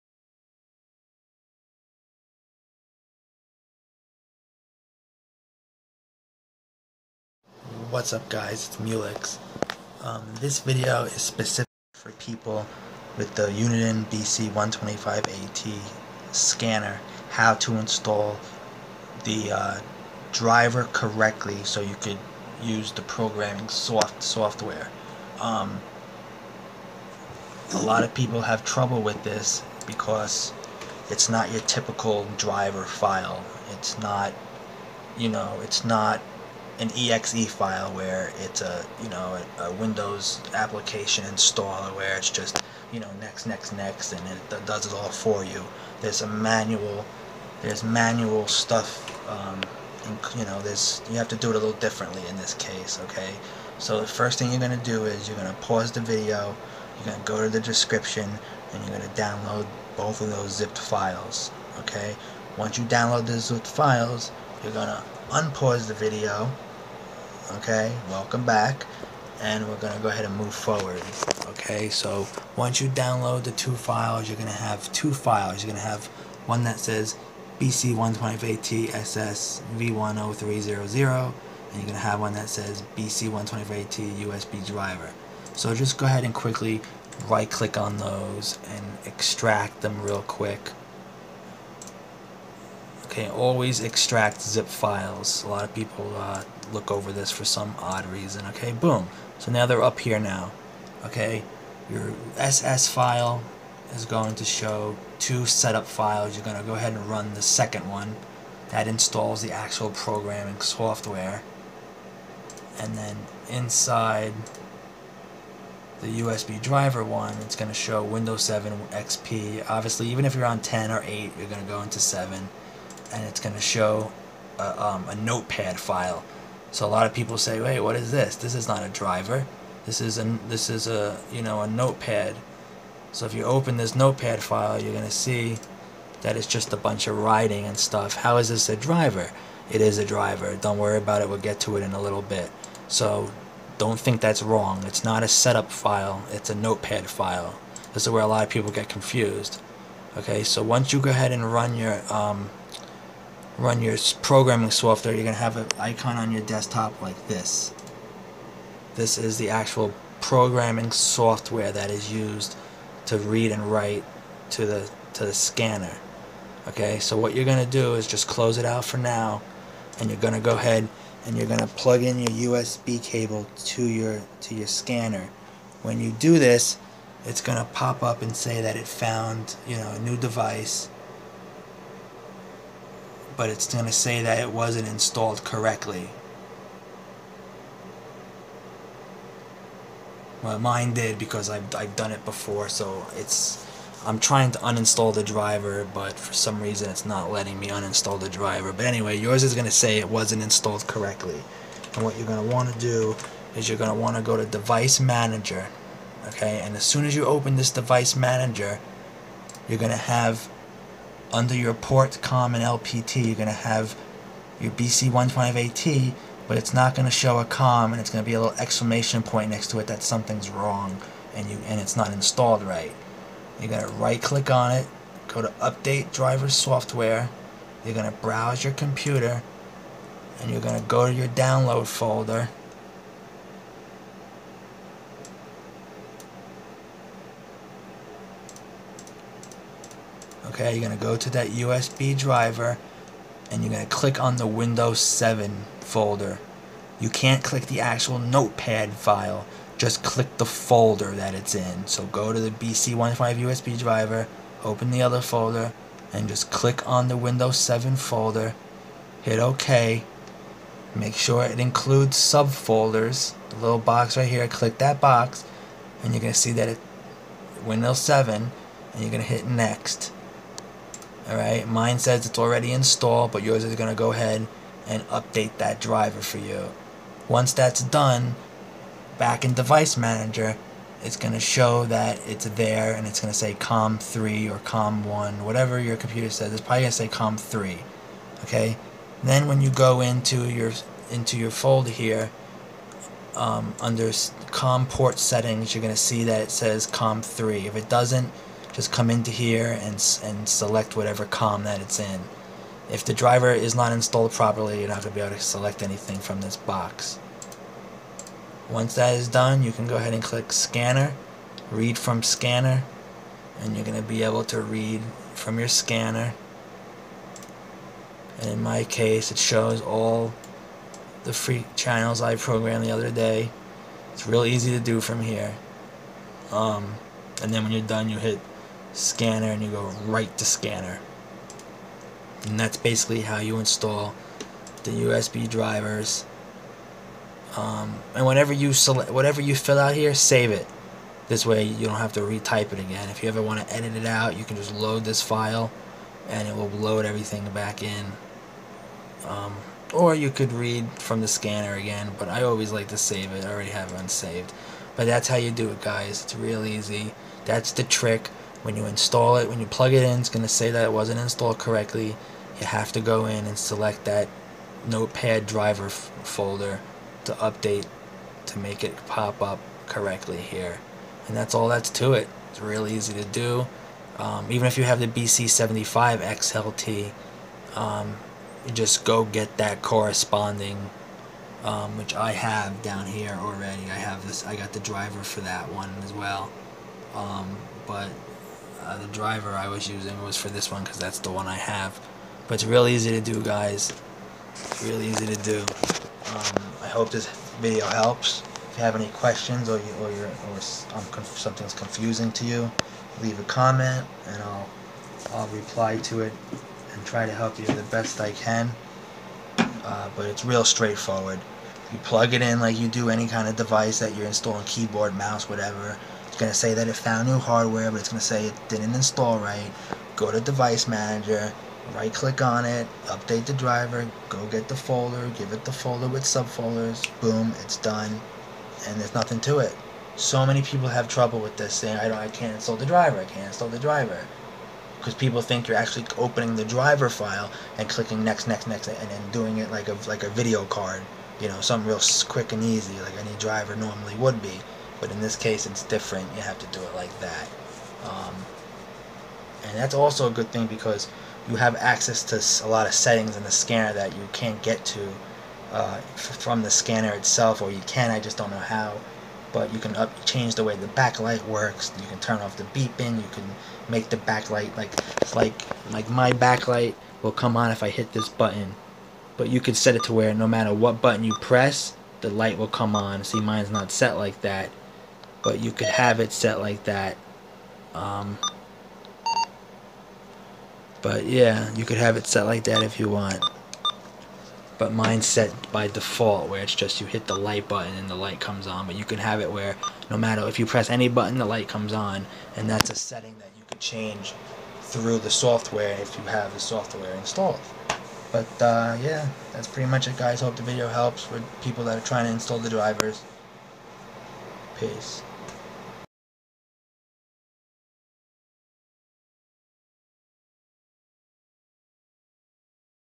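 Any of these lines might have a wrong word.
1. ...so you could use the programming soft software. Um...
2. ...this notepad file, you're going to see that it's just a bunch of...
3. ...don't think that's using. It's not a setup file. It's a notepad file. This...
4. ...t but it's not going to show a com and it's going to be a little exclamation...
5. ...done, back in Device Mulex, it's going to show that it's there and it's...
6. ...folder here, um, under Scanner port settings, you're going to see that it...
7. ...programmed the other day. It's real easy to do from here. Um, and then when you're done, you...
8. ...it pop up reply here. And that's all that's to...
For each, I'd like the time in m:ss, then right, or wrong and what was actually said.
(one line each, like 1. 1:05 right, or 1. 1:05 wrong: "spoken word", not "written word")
1. 0:21 right
2. 2:13 right
3. 2:23 wrong: "wrong", not "using"
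4. 3:35 right
5. 4:37 wrong: "Manager", not "Mulex"
6. 4:51 wrong: "COM", not "Scanner"
7. 5:22 right
8. 6:08 wrong: "correctly", not "reply".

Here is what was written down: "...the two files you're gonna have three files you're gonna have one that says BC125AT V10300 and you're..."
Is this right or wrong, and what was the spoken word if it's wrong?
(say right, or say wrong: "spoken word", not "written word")
wrong: "two", not "three".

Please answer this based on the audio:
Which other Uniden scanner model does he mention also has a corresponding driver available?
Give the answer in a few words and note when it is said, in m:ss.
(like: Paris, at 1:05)
BC75XLT, at 6:15.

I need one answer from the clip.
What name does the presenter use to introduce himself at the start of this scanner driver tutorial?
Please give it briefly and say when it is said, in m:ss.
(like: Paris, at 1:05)
Mulex, at 0:08.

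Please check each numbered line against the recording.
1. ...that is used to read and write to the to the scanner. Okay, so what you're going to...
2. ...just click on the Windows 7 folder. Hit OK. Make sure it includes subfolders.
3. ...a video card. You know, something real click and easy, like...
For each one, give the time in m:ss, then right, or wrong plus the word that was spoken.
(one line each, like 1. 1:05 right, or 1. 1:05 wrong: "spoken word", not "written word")
1. 2:41 right
2. 4:16 right
3. 7:20 wrong: "quick", not "click".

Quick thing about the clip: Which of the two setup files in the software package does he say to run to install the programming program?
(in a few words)
the second one.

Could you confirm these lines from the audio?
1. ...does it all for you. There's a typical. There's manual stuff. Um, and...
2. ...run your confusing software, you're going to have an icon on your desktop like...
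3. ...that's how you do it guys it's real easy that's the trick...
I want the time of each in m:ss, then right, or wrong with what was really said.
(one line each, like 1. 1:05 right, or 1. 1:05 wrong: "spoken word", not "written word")
1. 0:44 wrong: "manual", not "typical"
2. 2:33 wrong: "programming", not "confusing"
3. 5:55 right.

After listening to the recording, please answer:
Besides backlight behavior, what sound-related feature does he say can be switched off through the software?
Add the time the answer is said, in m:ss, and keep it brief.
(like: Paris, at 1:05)
the beeping, at 7:42.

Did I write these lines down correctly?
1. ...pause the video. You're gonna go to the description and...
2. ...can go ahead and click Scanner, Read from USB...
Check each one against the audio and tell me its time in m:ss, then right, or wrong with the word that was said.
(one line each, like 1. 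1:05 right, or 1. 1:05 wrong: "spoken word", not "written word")
1. 0:55 right
2. 5:09 wrong: "Scanner", not "USB".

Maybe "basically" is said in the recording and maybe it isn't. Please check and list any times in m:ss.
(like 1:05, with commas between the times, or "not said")
5:32.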